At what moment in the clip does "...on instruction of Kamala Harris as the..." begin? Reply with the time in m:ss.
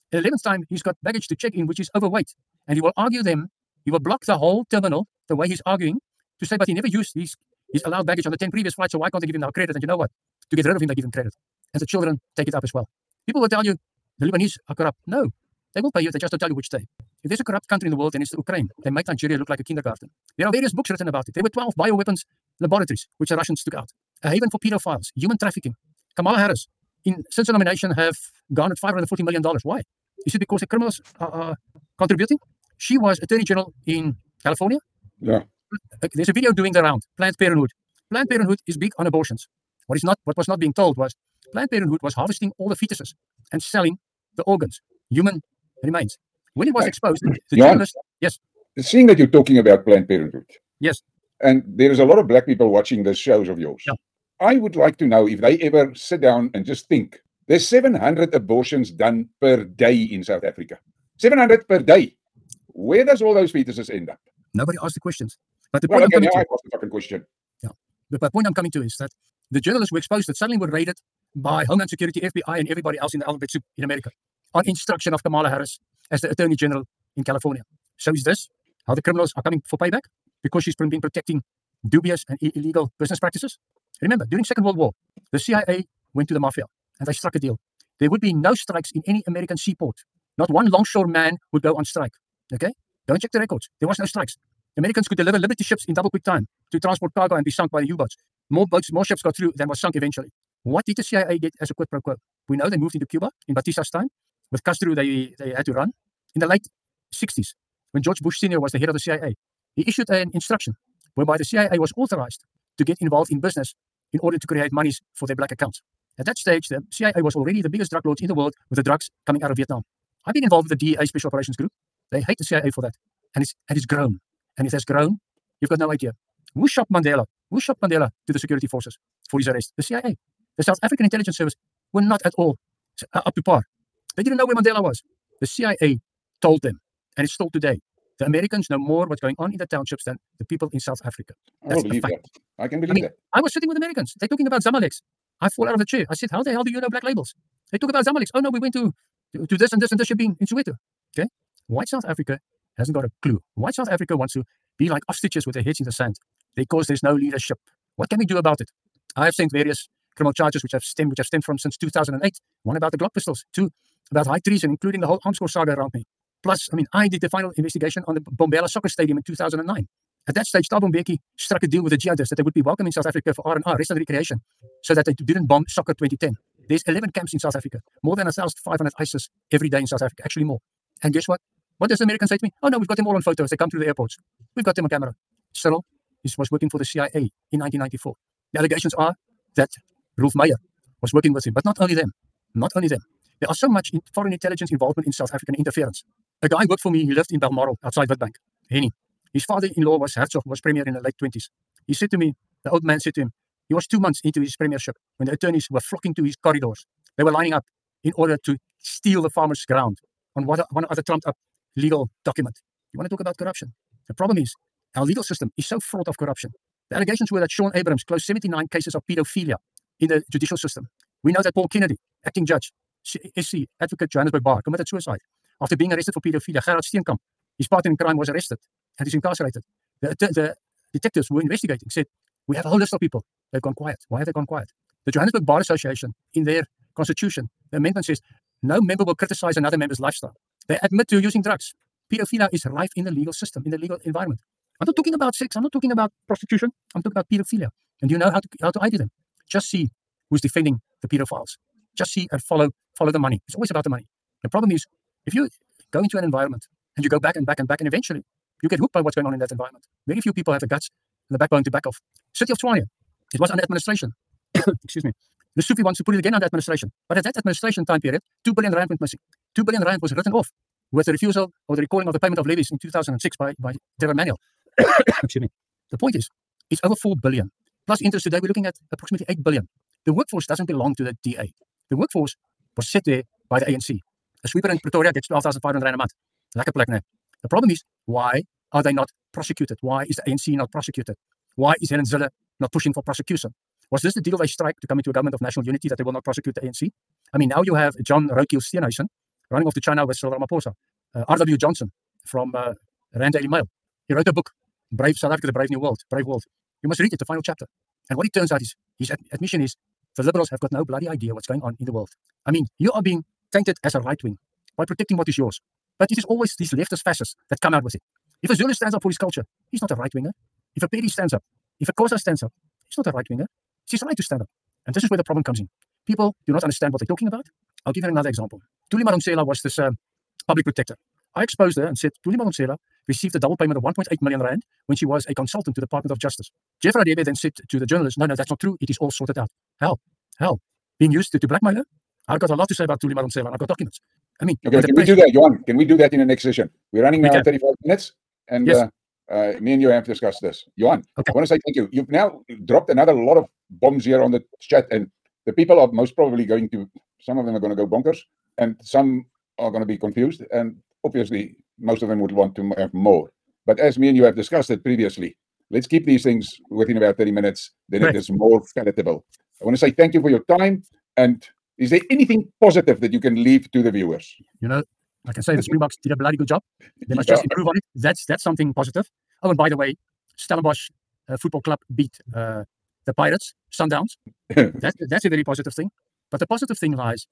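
1:14.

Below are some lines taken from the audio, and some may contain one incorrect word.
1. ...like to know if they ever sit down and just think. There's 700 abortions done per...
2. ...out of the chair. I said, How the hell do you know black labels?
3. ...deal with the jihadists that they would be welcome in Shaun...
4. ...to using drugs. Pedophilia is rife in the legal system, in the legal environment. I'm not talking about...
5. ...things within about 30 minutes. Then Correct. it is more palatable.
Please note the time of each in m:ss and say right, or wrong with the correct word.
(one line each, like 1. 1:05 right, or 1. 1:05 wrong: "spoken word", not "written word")
1. 0:54 right
2. 2:25 right
3. 2:51 wrong: "South", not "Shaun"
4. 4:01 right
5. 6:06 right.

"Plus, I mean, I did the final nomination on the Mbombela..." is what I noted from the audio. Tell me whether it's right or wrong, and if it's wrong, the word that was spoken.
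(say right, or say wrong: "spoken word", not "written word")
wrong: "investigation", not "nomination".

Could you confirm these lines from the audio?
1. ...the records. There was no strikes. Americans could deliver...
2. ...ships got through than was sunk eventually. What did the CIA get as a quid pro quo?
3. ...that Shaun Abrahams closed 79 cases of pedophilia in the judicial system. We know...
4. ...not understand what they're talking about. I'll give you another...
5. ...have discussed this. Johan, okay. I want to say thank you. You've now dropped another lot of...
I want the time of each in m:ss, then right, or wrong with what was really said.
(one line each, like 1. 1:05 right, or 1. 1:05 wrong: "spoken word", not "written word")
1. 1:33 right
2. 1:39 right
3. 3:37 right
4. 5:26 right
5. 5:49 right.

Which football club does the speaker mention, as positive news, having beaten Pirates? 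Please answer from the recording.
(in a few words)
Stellenbosch.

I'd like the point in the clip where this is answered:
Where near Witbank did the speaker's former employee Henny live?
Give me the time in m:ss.
3:17.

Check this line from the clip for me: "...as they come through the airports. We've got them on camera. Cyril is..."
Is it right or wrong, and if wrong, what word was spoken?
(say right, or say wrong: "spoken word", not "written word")
right.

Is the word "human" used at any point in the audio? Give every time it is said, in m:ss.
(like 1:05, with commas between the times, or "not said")
0:25, 0:45.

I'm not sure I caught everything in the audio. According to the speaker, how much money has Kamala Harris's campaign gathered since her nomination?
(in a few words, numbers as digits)
$540 million.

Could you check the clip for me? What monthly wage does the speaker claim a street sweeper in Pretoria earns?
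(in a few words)
12,500 rand.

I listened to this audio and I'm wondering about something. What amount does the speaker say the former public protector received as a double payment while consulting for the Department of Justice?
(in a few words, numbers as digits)
1.8 million rand.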